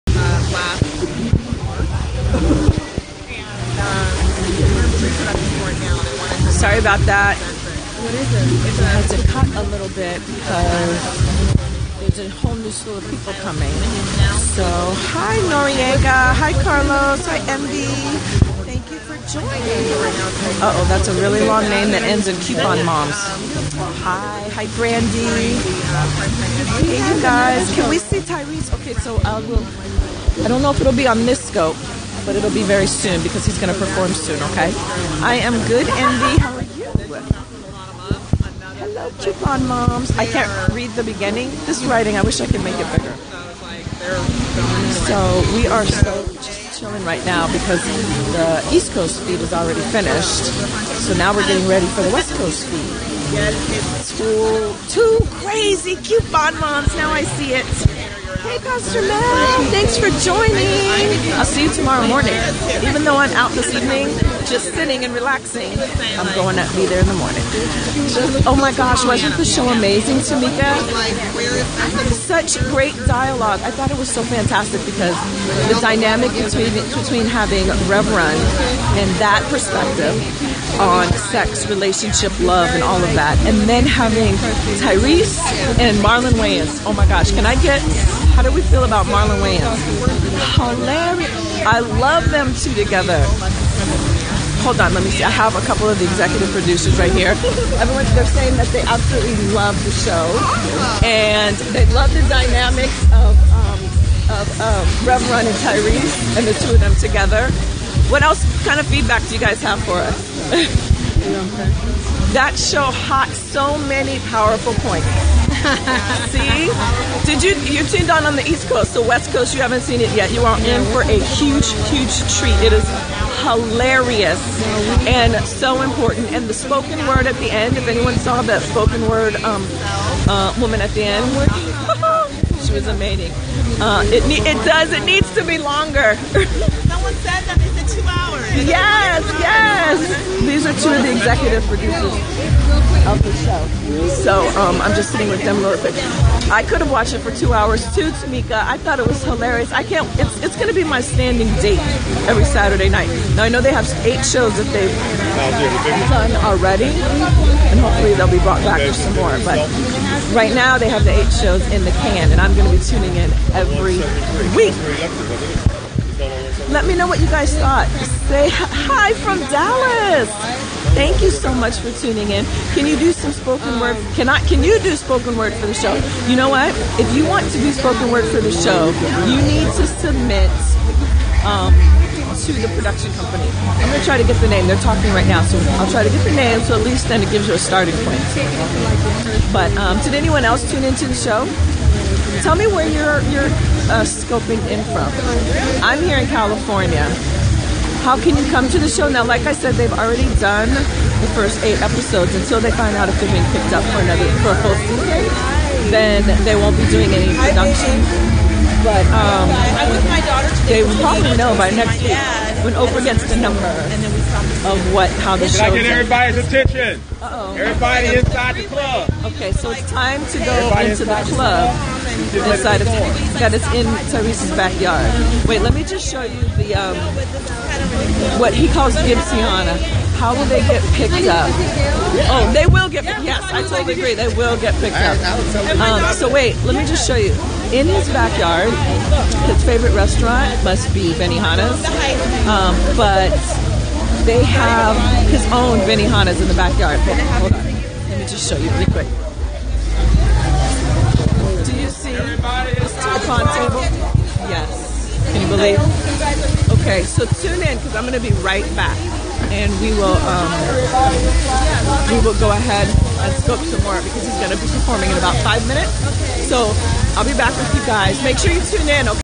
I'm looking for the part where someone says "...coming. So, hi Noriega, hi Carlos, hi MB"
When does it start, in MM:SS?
00:13.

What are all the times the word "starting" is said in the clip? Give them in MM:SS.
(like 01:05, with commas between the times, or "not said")
03:07.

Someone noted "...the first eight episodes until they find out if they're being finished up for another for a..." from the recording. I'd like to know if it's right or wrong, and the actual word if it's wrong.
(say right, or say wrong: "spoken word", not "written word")
wrong: "picked", not "finished".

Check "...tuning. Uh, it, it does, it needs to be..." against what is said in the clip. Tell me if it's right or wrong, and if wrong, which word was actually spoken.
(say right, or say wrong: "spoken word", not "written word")
wrong: "amazing", not "tuning".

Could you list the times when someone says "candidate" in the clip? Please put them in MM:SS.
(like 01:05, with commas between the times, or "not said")
not said.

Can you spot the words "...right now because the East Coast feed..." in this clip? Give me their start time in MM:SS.
00:47.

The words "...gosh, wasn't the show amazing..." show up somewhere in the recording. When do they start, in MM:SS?
01:08.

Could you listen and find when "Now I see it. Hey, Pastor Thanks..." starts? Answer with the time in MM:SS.
00:56.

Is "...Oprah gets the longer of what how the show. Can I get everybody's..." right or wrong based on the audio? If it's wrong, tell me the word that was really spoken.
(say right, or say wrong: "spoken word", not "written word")
wrong: "number", not "longer".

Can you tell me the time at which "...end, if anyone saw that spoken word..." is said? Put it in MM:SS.
02:07.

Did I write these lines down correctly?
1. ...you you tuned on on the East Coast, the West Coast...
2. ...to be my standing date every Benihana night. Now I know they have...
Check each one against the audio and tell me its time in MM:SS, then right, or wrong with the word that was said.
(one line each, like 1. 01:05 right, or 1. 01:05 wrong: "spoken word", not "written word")
1. 01:57 right
2. 02:30 wrong: "Saturday", not "Benihana".